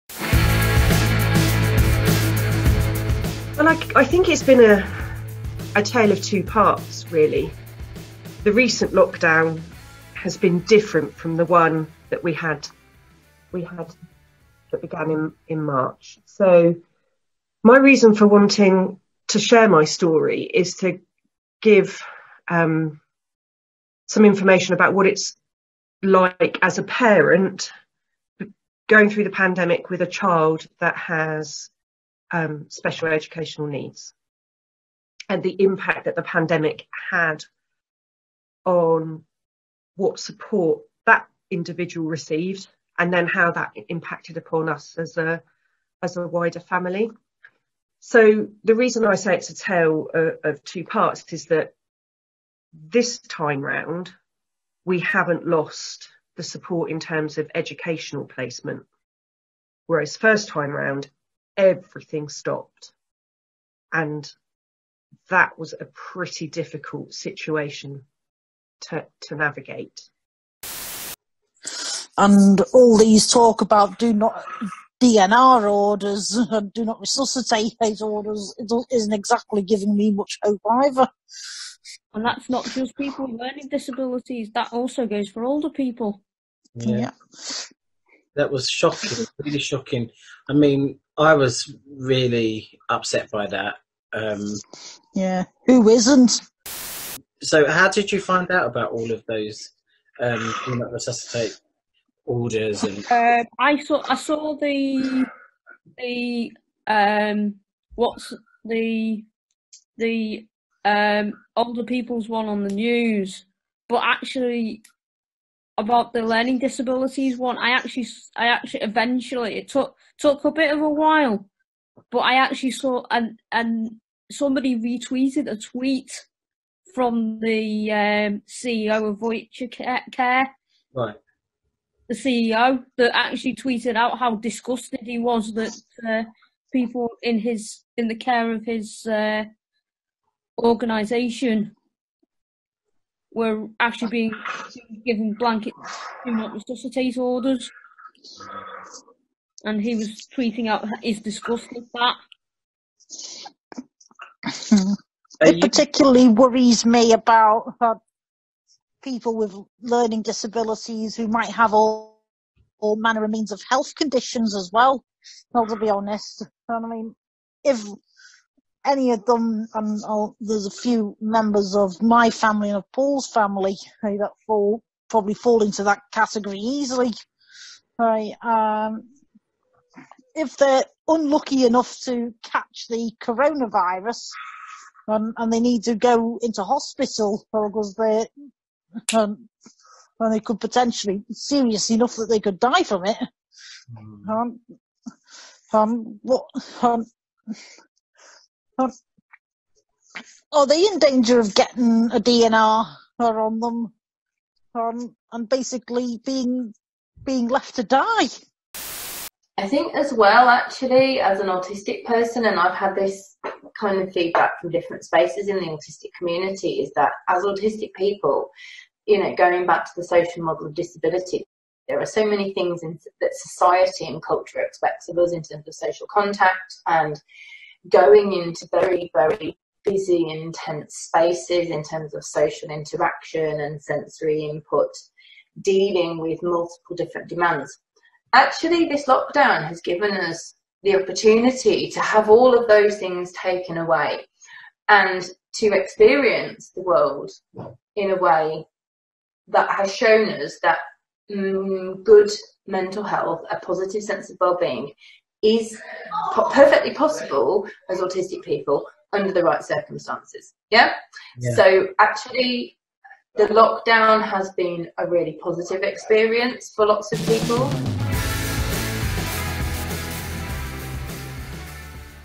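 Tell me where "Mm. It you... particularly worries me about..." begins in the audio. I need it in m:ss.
2:34.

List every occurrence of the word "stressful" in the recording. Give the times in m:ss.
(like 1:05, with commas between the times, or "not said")
not said.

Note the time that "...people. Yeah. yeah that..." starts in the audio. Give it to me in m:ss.
1:25.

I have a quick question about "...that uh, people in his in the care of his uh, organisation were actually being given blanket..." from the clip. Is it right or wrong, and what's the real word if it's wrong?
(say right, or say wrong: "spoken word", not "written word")
right.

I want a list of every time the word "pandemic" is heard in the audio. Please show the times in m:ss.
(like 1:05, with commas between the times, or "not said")
0:29, 0:36.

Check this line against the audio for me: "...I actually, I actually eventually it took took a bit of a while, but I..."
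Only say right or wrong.
right.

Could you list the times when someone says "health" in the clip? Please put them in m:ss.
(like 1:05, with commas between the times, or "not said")
2:43, 4:13.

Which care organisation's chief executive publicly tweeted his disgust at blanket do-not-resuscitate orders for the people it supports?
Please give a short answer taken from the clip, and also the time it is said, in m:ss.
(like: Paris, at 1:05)
Voyager Care, at 2:09.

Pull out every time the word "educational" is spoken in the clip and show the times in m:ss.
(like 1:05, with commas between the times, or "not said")
0:33, 0:57.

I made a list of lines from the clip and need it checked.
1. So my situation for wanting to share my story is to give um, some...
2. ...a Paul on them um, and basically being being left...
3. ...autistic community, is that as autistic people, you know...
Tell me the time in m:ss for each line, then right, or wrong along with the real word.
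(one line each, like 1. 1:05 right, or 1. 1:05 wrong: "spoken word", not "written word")
1. 0:16 wrong: "reason", not "situation"
2. 3:22 wrong: "DNR", not "Paul"
3. 3:35 right.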